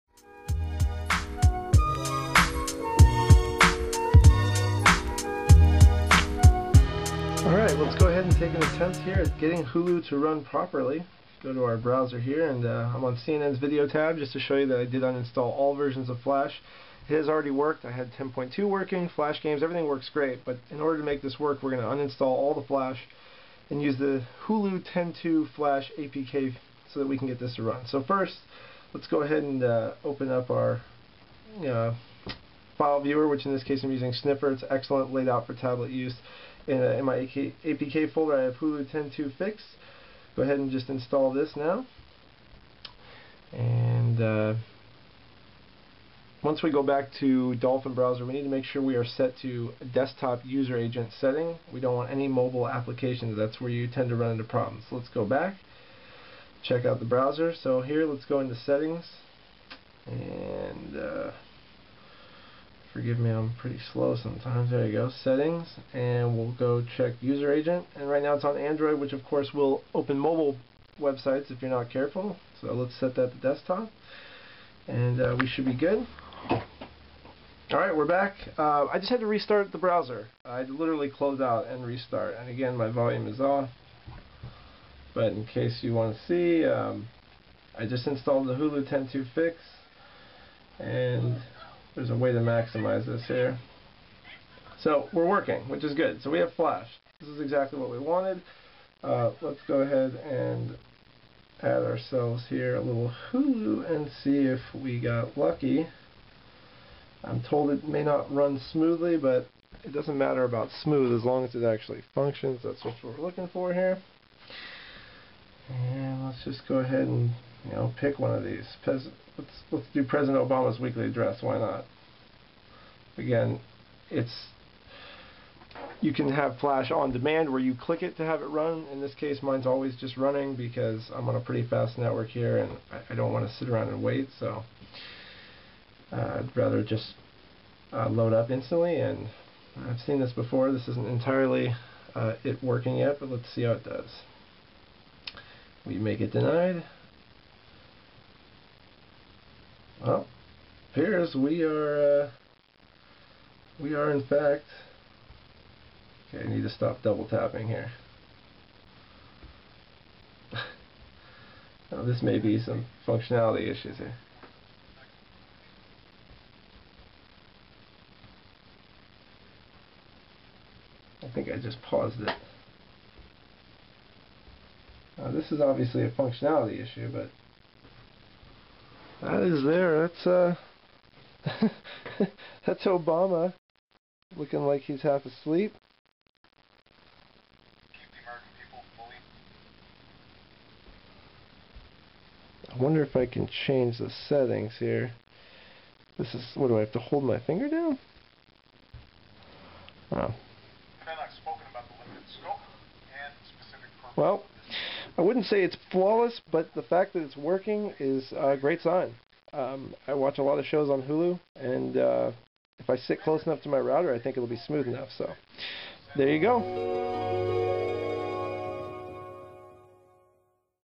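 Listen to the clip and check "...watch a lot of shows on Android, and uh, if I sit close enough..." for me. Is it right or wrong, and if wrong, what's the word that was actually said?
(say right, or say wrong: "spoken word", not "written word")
wrong: "Hulu", not "Android".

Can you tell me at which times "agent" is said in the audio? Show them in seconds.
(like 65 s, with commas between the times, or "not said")
50 s, 67 s.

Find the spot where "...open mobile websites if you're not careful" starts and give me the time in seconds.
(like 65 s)
69 s.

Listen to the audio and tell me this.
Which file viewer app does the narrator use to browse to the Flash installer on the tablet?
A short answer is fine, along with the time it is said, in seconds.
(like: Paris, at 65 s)
Sniffer, at 34 s.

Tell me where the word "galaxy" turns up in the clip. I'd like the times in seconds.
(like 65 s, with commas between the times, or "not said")
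not said.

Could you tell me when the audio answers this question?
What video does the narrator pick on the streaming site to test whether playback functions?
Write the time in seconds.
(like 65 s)
120 s.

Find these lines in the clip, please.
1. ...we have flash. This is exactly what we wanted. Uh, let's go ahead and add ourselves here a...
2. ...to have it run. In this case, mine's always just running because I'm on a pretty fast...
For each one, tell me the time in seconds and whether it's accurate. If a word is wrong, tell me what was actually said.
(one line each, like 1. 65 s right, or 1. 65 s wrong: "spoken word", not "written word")
1. 96 s right
2. 128 s right.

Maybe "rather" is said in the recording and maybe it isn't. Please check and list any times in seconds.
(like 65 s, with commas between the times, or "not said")
136 s.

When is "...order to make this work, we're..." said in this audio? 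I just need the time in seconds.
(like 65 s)
20 s.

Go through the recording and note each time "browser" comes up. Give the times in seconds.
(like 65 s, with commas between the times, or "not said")
11 s, 47 s, 57 s, 79 s.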